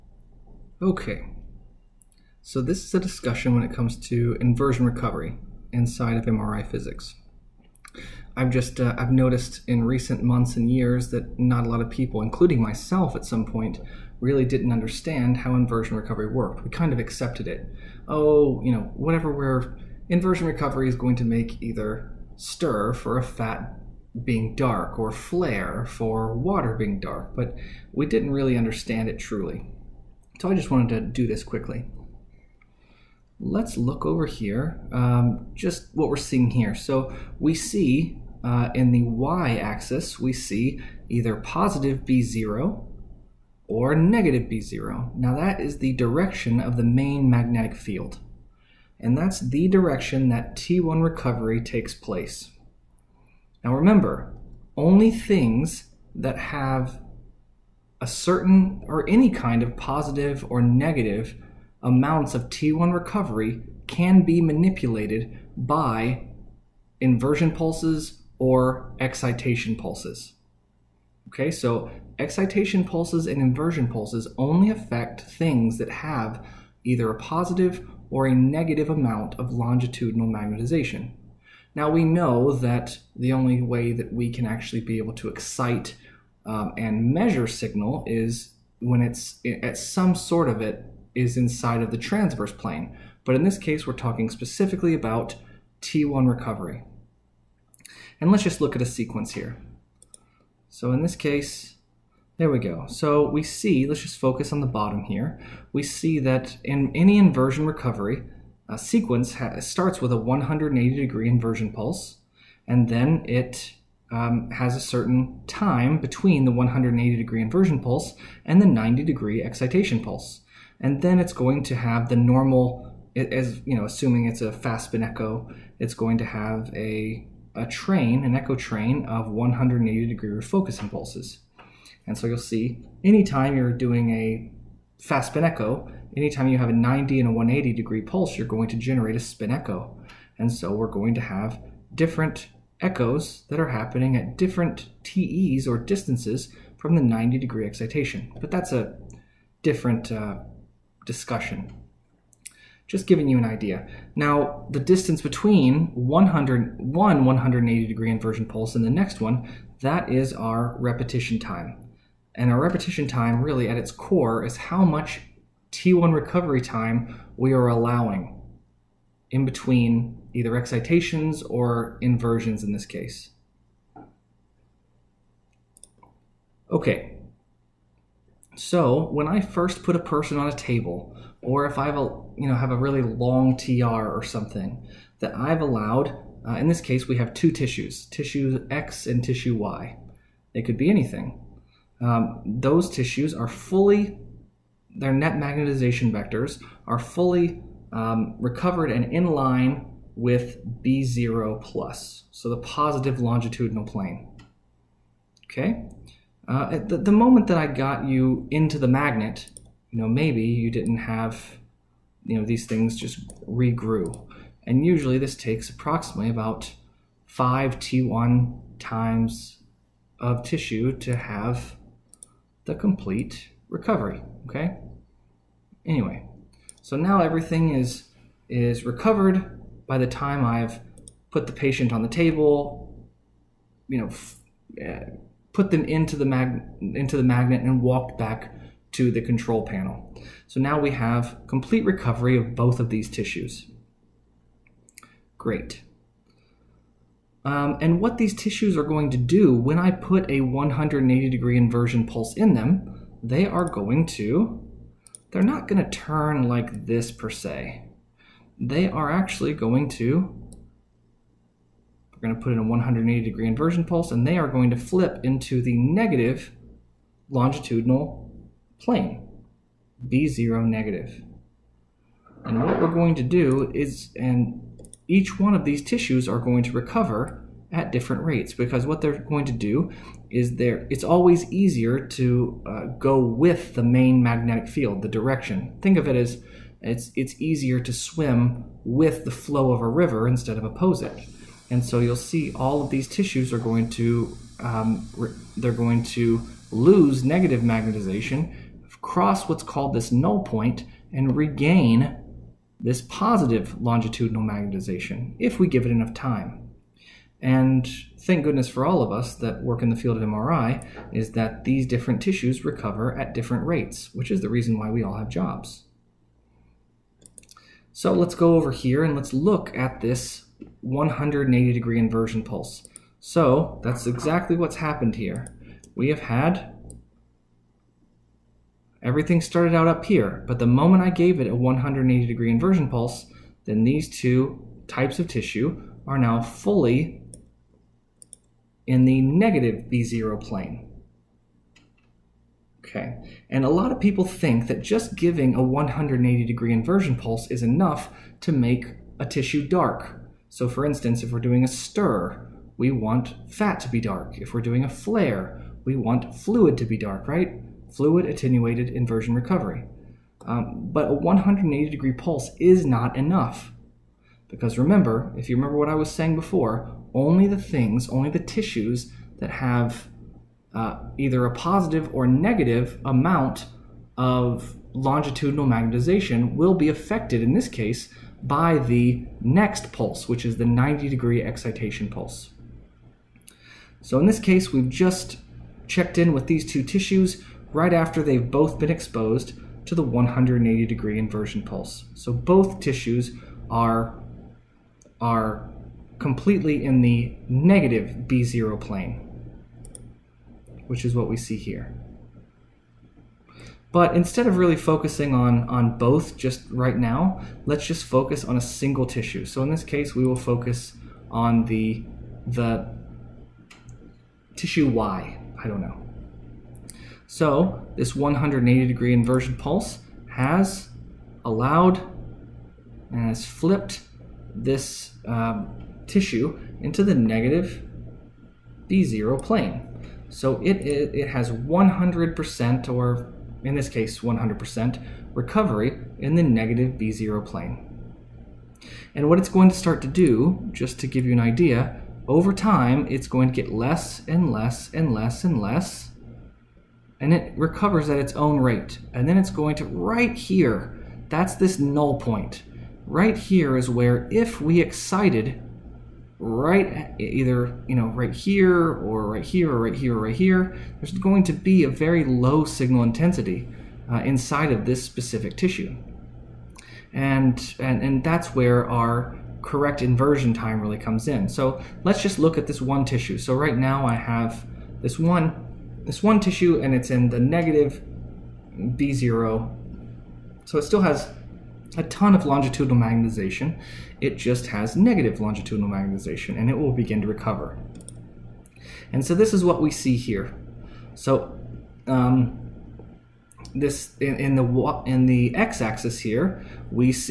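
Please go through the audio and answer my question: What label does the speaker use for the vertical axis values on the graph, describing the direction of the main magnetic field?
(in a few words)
positive B0 or negative B0.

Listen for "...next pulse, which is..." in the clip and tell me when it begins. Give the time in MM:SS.
06:19.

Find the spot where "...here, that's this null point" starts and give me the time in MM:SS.
07:30.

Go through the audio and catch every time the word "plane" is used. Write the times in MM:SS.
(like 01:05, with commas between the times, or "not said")
01:32, 03:23, 04:28, 05:40, 06:38, 07:09, 07:17.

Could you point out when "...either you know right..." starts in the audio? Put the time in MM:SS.
07:37.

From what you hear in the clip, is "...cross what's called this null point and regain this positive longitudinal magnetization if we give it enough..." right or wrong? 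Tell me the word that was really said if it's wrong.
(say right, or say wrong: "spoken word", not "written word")
right.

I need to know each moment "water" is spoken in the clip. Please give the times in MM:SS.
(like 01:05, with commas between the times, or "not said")
00:26.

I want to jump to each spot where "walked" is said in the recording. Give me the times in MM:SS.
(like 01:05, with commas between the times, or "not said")
03:57.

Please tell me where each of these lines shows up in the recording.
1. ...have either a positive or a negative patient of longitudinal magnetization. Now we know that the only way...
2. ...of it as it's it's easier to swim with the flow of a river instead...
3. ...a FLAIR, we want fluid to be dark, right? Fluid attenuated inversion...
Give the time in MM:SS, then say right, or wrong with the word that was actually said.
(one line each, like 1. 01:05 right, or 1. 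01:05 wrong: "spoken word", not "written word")
1. 01:15 wrong: "amount", not "patient"
2. 04:45 right
3. 05:54 right.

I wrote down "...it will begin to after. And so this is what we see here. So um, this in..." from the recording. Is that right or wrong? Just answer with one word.
wrong.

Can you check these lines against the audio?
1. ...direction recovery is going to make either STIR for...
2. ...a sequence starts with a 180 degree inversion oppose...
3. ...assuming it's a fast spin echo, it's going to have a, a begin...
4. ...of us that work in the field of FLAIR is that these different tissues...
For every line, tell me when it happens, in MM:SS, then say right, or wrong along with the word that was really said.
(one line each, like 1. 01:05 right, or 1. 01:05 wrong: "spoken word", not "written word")
1. 00:20 wrong: "inversion", not "direction"
2. 01:48 wrong: "pulse", not "oppose"
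3. 02:03 wrong: "train", not "begin"
4. 05:09 wrong: "MRI", not "FLAIR".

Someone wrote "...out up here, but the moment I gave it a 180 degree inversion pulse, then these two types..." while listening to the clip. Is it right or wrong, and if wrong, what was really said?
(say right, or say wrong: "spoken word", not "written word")
right.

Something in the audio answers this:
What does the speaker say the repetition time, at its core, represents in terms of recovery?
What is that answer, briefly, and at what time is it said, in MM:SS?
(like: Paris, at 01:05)
T1 recovery time, at 02:45.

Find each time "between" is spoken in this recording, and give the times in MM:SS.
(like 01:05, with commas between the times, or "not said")
01:55, 02:35, 02:49.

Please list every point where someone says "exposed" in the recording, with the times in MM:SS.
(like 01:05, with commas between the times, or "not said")
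06:28.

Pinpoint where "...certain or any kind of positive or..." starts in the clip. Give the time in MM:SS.
00:58.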